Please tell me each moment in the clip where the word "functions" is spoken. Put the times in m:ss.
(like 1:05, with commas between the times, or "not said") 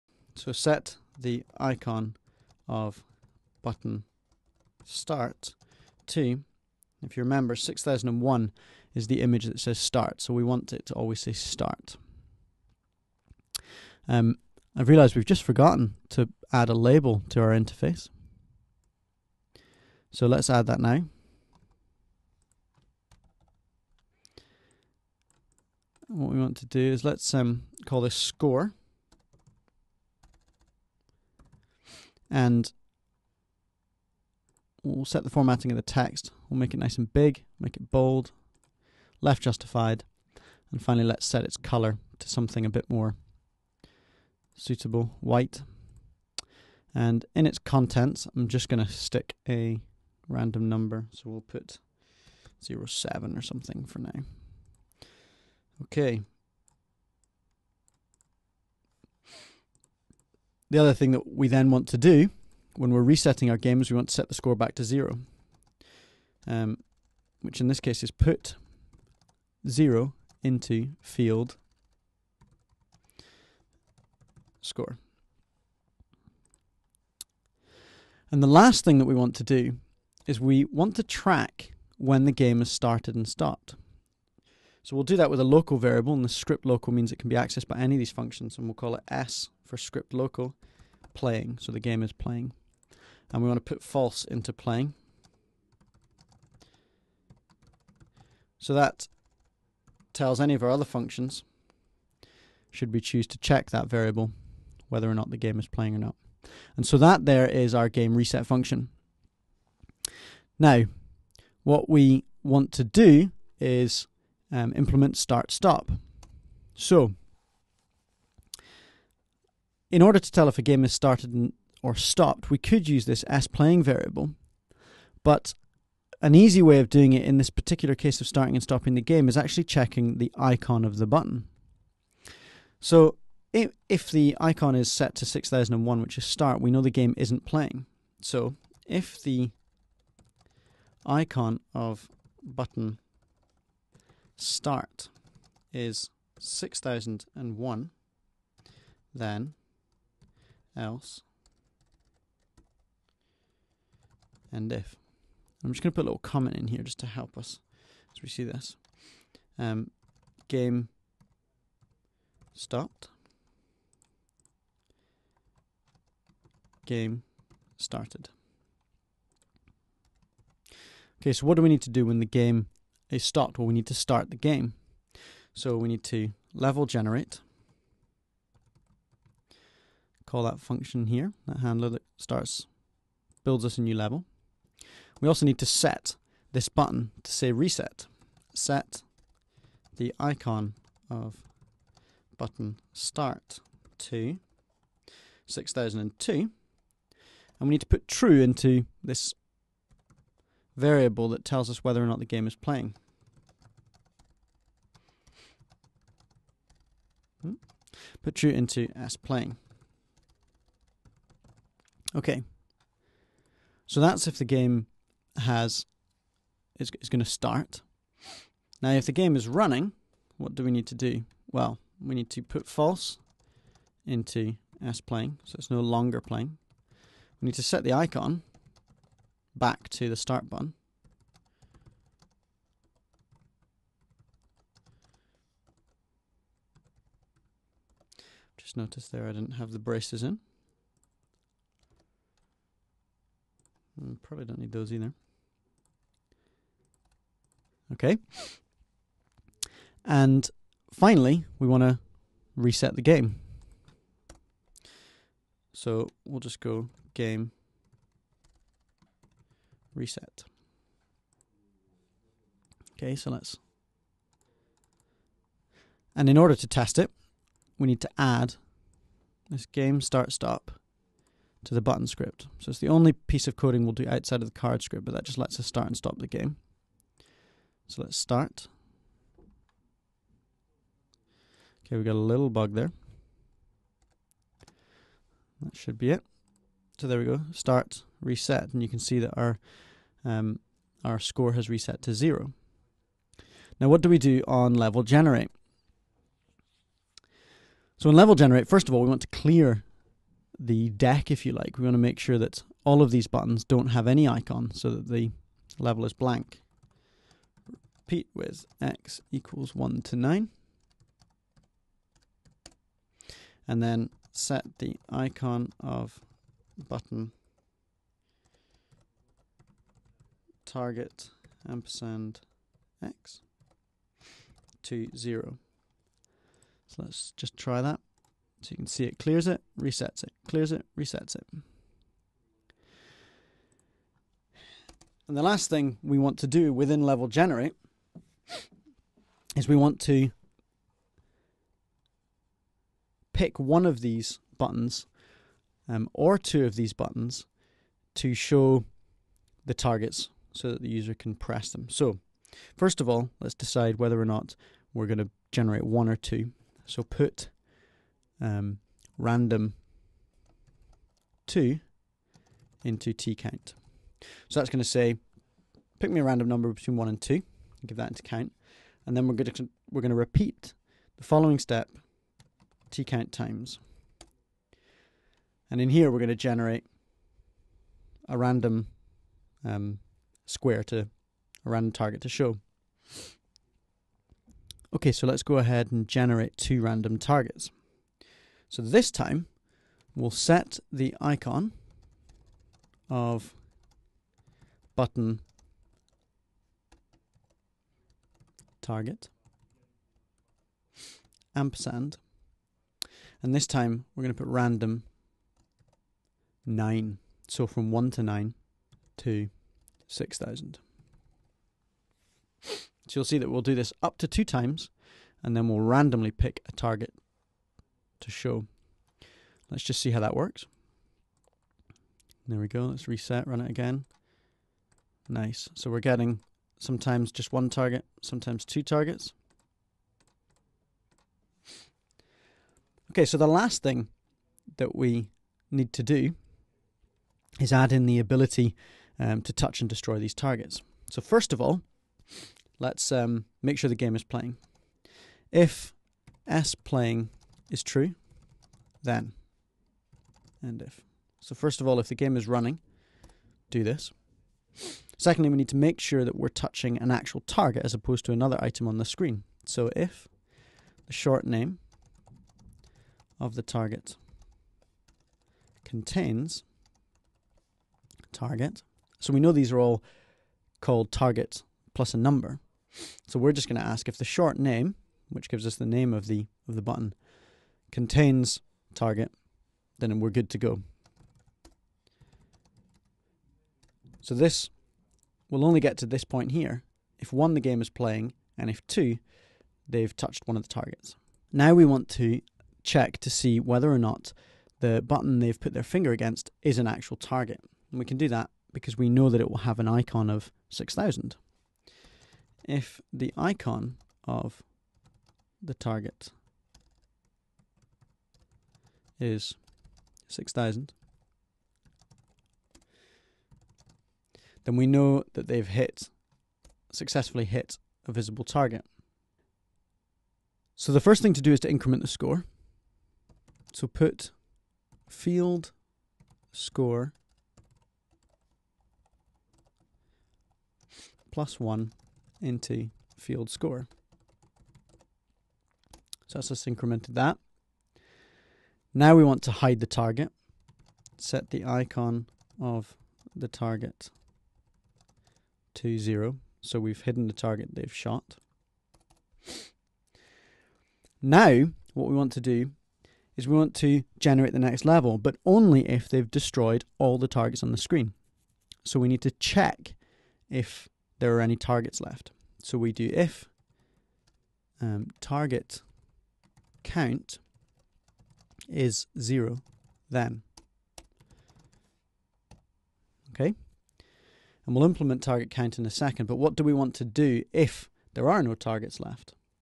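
1:28, 1:40, 1:48, 3:00.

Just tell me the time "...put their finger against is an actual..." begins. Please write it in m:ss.
8:15.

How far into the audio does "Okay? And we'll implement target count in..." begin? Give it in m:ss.
9:33.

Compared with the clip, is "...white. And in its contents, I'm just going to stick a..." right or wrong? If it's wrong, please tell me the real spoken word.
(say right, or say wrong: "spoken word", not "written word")
right.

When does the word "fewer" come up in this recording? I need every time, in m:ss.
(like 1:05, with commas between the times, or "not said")
not said.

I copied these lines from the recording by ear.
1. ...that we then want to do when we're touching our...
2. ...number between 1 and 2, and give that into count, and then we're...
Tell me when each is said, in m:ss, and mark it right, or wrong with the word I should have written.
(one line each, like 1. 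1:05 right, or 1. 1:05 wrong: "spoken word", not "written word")
1. 1:01 wrong: "resetting", not "touching"
2. 6:06 right.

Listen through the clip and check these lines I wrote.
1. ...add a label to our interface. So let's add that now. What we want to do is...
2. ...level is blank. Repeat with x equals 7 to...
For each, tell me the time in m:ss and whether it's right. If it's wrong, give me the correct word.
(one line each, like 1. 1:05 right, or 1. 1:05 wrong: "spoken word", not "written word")
1. 0:16 right
2. 5:05 wrong: "1", not "7".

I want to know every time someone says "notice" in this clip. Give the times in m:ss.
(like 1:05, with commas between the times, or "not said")
3:58.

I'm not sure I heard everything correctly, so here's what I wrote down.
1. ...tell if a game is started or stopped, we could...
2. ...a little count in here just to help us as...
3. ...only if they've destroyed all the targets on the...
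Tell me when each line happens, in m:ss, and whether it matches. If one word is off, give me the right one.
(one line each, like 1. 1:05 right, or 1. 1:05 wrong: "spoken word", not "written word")
1. 2:00 right
2. 2:36 wrong: "comment", not "count"
3. 9:15 right.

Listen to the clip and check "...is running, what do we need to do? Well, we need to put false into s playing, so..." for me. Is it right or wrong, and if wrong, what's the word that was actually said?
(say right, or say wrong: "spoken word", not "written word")
right.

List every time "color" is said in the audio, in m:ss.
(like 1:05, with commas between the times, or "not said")
0:41.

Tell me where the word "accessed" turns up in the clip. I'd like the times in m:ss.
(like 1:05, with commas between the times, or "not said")
1:27.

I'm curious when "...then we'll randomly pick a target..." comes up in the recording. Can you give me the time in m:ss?
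6:55.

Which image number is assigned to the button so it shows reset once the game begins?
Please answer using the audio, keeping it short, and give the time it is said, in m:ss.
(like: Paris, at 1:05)
6002, at 3:15.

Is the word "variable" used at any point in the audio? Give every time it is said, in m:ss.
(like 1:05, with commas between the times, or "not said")
1:25, 1:43, 2:03, 3:20.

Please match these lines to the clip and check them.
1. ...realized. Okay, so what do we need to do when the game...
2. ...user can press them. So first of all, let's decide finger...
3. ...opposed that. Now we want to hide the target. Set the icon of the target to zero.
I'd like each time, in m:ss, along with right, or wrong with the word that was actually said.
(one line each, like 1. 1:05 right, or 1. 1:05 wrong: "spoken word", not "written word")
1. 2:47 wrong: "started", not "realized"
2. 5:50 wrong: "whether", not "finger"
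3. 8:56 wrong: "incremented", not "opposed".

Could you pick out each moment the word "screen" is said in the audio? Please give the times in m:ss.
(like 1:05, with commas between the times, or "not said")
7:39, 9:17.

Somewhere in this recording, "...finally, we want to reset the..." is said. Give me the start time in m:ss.
4:10.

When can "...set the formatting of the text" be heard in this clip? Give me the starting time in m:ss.
0:35.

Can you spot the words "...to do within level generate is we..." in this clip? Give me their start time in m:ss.
5:36.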